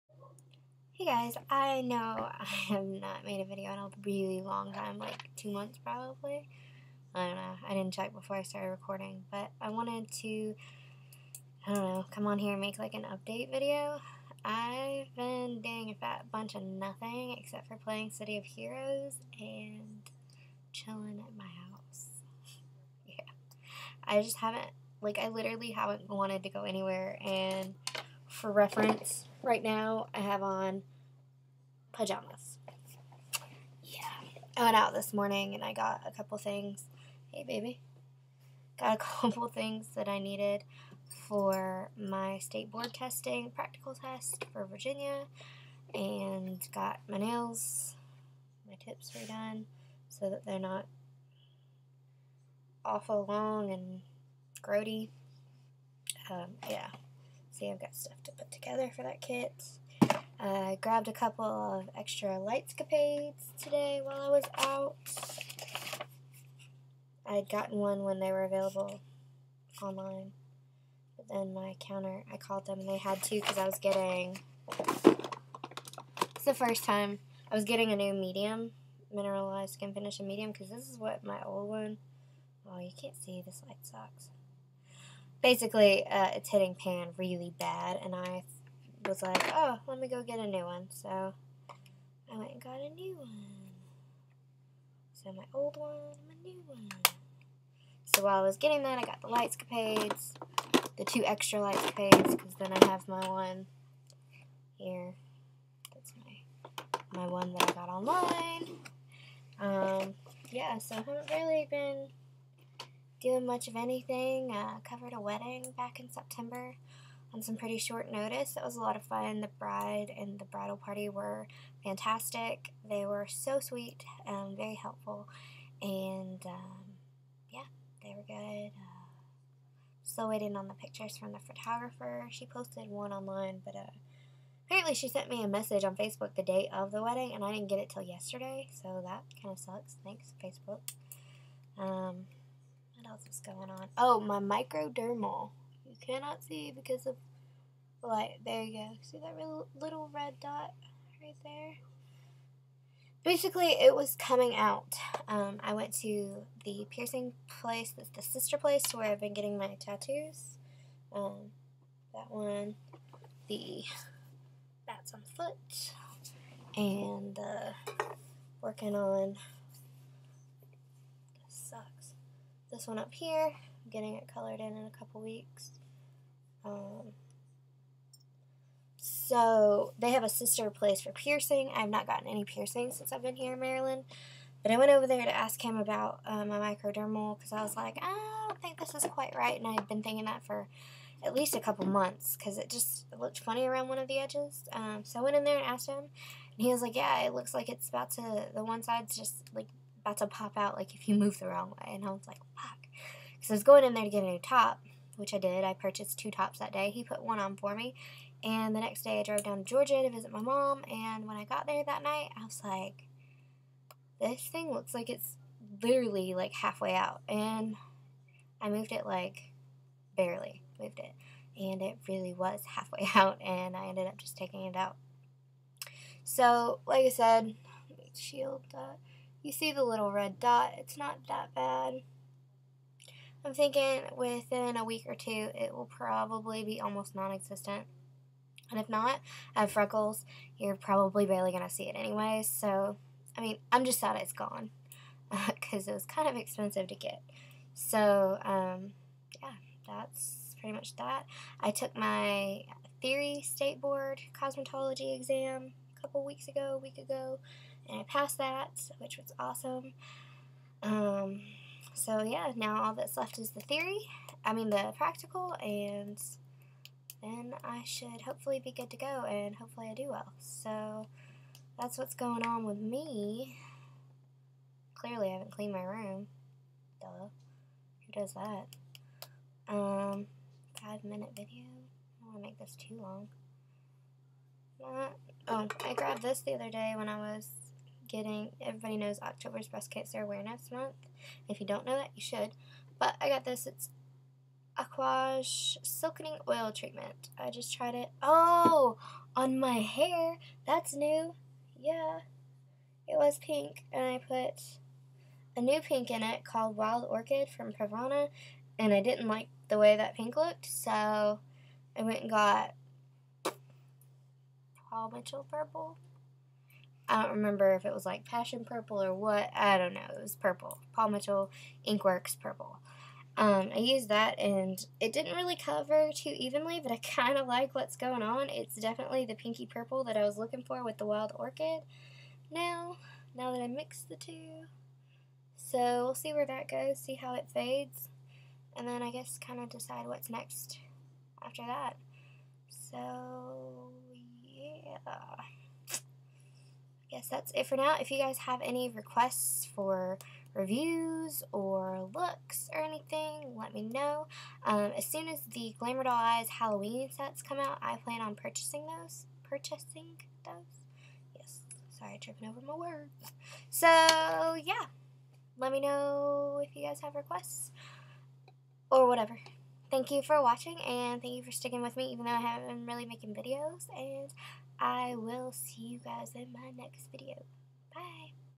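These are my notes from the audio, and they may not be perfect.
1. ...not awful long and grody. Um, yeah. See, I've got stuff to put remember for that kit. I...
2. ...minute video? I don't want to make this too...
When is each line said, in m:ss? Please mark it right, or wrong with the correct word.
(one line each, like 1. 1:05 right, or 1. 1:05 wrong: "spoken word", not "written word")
1. 0:50 wrong: "together", not "remember"
2. 4:41 right.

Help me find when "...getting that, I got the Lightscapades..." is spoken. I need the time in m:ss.
1:38.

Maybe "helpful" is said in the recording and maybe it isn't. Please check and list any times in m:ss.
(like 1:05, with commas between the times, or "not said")
2:04.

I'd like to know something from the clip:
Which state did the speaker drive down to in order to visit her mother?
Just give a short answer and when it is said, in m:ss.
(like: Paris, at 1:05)
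Georgia, at 3:29.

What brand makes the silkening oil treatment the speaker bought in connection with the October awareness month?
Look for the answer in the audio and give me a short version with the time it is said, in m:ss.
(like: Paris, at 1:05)
Aquage, at 4:54.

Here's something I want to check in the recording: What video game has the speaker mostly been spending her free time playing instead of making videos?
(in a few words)
City of Heroes.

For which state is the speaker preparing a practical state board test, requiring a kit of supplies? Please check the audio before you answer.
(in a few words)
Virginia.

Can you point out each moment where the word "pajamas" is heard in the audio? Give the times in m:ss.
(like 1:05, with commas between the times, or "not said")
0:31.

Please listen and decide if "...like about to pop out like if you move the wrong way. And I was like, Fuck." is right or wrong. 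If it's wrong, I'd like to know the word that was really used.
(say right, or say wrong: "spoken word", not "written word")
right.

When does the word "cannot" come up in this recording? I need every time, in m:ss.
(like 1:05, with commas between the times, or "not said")
2:26.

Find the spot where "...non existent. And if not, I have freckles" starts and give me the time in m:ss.
3:57.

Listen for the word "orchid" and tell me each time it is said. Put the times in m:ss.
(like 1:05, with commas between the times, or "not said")
5:07, 5:31.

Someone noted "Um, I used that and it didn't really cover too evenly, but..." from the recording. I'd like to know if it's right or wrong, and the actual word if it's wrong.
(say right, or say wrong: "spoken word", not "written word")
right.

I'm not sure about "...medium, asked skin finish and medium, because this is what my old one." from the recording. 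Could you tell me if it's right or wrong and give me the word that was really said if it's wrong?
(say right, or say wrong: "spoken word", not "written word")
wrong: "mineralized", not "asked".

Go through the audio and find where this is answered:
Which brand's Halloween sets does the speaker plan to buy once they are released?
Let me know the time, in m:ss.
5:55.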